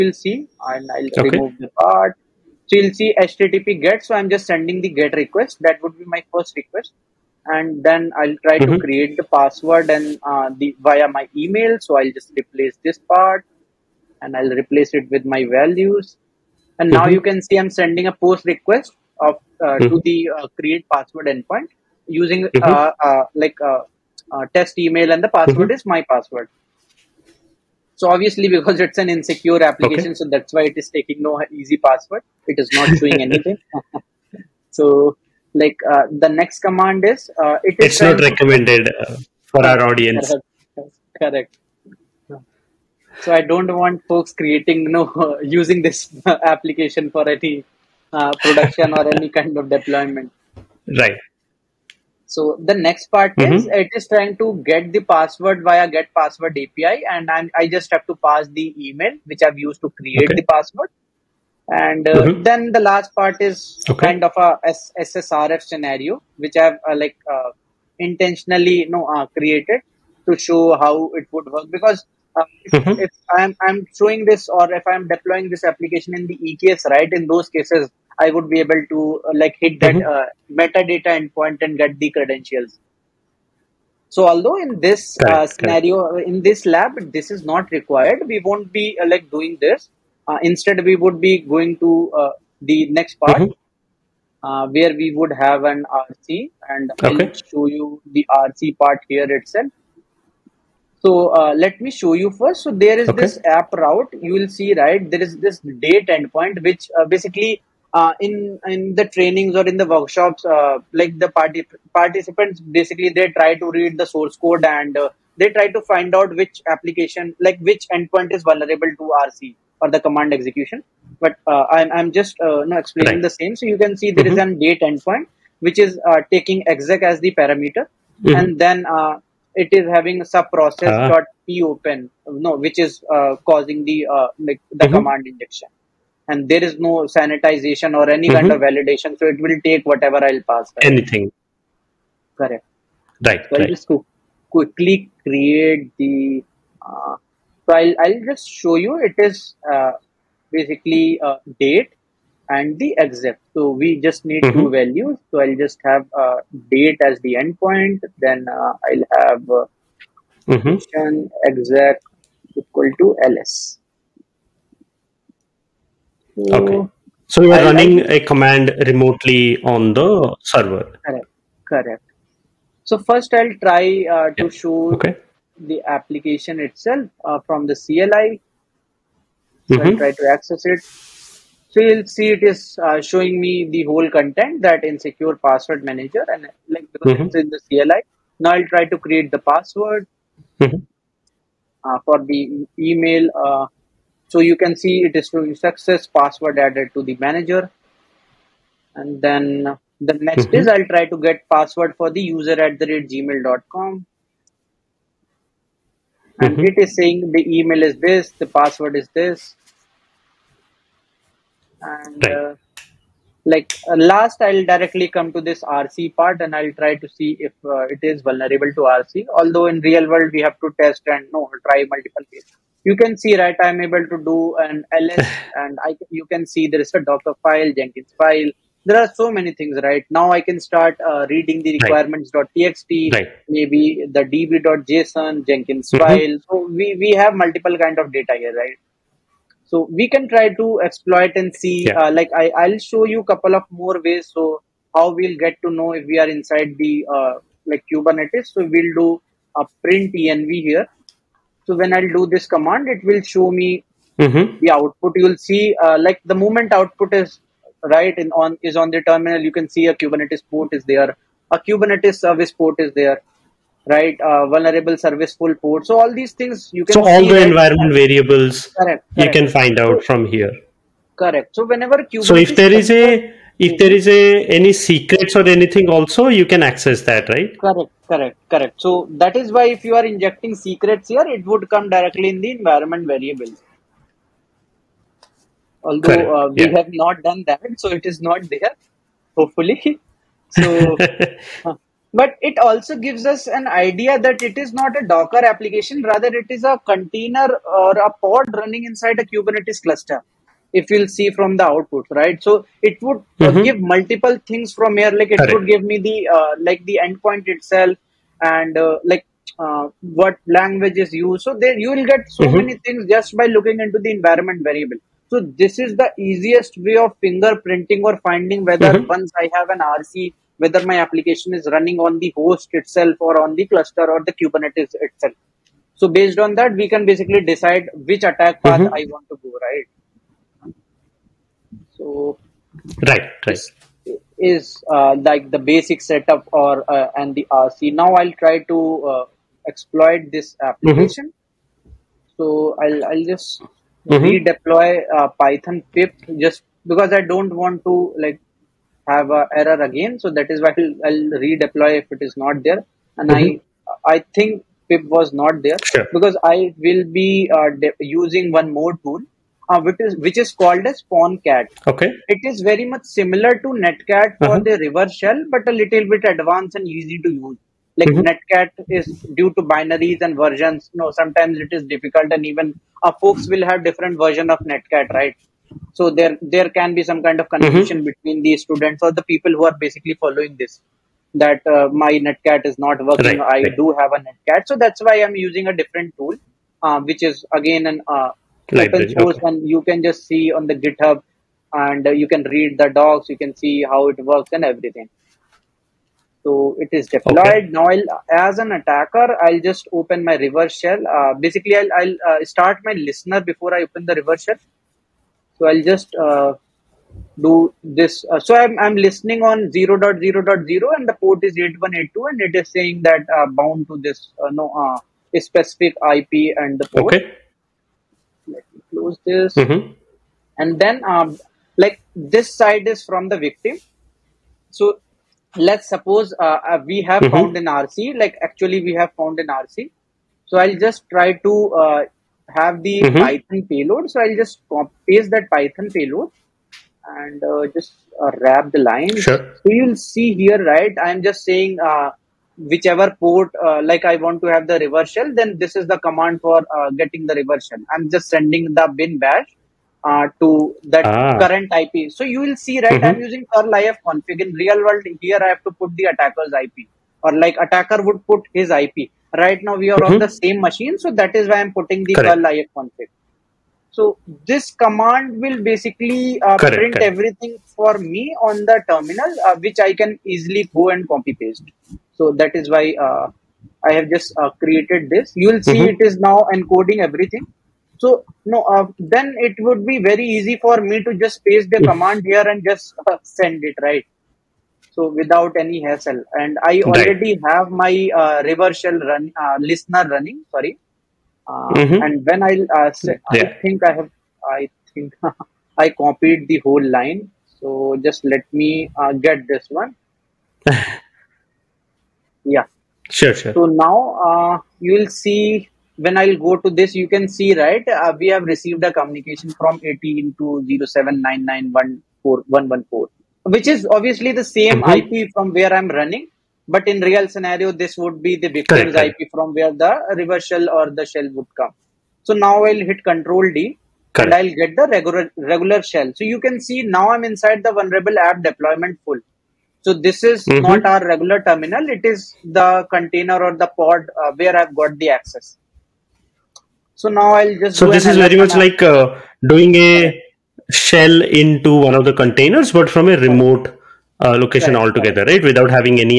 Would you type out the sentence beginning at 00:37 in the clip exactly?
It's not recommended uh, for our audience.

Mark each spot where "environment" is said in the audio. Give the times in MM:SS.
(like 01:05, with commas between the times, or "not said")
04:27, 04:42, 05:14.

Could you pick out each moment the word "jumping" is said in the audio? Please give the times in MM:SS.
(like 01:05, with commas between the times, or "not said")
not said.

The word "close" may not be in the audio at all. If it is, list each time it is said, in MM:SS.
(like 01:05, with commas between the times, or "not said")
06:58.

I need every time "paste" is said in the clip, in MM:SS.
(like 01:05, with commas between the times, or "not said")
07:15, 07:51, 08:01.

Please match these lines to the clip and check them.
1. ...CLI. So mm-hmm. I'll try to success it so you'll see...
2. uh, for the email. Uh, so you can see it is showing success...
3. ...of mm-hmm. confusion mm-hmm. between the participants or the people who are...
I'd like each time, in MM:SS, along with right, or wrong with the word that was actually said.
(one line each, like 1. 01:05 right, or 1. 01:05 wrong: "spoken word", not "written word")
1. 02:57 wrong: "access", not "success"
2. 03:11 right
3. 06:17 wrong: "students", not "participants".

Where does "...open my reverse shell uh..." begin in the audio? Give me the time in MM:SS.
06:39.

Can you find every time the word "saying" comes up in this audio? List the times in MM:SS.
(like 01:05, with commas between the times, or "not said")
03:26, 06:52, 07:21.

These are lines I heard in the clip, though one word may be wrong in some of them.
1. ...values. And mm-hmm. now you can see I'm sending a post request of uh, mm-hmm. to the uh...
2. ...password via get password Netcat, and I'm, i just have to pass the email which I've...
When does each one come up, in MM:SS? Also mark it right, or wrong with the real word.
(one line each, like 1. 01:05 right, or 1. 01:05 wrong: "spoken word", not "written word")
1. 00:15 right
2. 00:54 wrong: "API", not "Netcat".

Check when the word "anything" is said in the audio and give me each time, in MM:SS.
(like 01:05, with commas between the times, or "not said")
00:33, 02:20, 04:35.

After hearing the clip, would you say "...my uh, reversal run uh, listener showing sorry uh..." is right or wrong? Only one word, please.
wrong.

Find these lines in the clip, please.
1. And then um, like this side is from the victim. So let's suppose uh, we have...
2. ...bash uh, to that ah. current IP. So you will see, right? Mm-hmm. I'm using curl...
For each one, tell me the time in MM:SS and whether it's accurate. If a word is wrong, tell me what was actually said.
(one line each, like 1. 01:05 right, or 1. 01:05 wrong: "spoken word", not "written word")
1. 07:00 right
2. 07:29 right.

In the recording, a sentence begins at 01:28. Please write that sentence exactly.
We won't be uh, like doing this.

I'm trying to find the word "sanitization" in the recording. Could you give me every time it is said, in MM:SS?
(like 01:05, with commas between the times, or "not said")
02:17.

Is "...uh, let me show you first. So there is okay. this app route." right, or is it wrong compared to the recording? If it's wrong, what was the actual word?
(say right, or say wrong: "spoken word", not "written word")
right.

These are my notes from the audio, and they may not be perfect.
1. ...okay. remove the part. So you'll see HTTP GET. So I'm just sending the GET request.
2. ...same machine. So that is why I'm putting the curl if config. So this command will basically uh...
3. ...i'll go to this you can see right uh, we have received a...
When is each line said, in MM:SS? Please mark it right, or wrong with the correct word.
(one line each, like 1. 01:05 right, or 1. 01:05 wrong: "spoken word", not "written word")
1. 00:01 right
2. 07:40 right
3. 08:26 right.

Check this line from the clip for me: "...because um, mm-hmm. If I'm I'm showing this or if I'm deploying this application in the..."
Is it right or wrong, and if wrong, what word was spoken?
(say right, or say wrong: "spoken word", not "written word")
right.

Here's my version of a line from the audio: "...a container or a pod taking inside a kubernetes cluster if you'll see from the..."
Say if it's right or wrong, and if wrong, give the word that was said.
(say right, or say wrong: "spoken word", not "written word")
wrong: "running", not "taking".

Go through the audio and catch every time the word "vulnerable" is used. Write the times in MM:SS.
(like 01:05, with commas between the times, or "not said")
01:58, 03:38, 04:24, 08:47.